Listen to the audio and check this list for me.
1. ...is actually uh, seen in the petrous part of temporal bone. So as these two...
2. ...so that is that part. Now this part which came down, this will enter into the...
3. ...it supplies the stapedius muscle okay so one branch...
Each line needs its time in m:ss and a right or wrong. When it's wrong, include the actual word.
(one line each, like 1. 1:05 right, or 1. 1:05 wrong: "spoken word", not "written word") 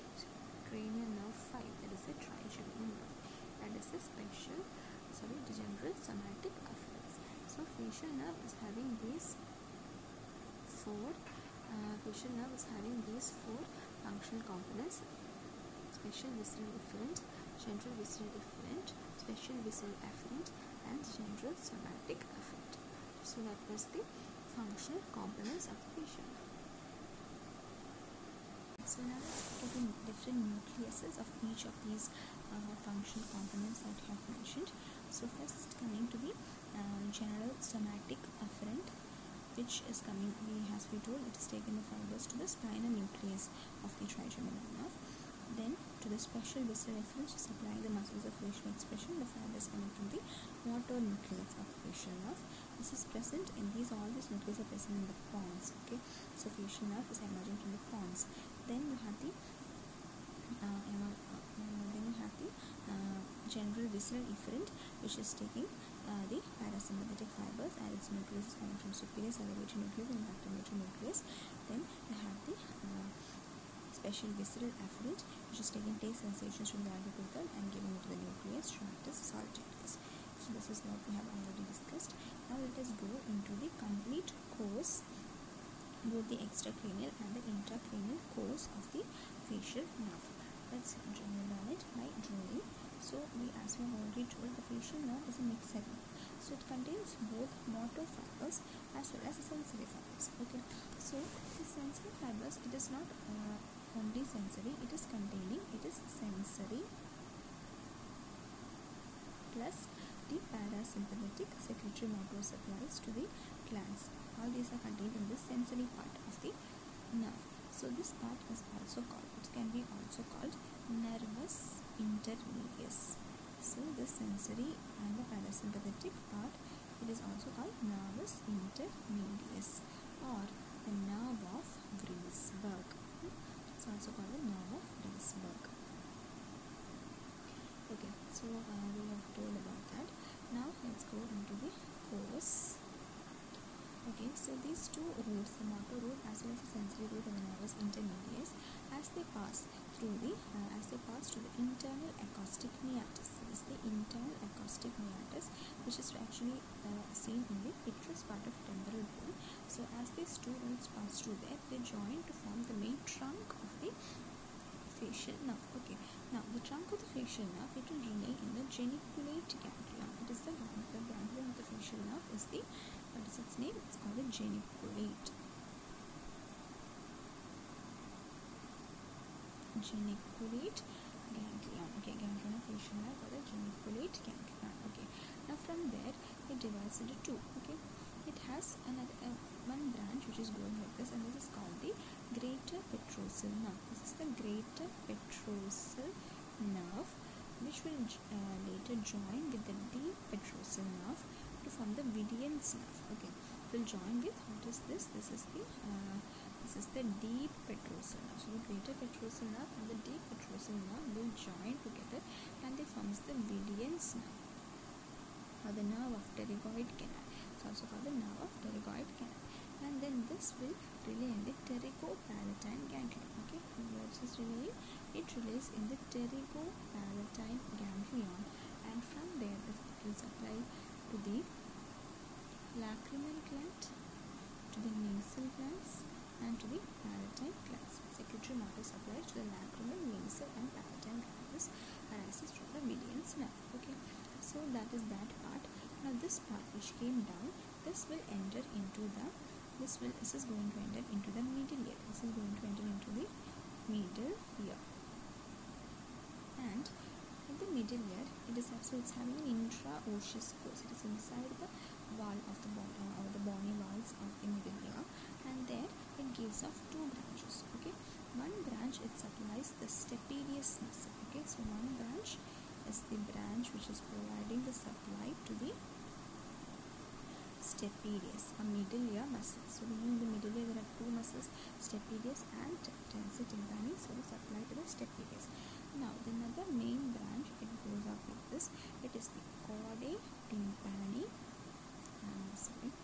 1. 2:35 right
2. 4:04 right
3. 4:29 right.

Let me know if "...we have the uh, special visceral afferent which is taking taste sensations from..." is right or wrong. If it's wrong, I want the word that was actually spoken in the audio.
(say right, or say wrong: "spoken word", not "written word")
right.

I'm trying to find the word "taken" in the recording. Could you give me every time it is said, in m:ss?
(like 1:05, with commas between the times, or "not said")
0:41.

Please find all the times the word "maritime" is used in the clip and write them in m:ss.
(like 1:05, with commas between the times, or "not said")
3:57.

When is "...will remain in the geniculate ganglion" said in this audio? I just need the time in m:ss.
2:47.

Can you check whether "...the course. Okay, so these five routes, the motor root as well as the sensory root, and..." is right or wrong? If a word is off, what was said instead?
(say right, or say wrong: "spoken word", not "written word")
wrong: "two", not "five".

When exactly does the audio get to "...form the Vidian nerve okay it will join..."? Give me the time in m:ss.
3:21.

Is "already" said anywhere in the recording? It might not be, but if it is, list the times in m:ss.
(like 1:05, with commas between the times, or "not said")
1:21, 1:33.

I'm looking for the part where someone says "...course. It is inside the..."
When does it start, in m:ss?
4:20.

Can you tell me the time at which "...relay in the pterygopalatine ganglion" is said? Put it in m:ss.
3:41.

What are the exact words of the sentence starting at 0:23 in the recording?
So that was the functional components of the facial nerve.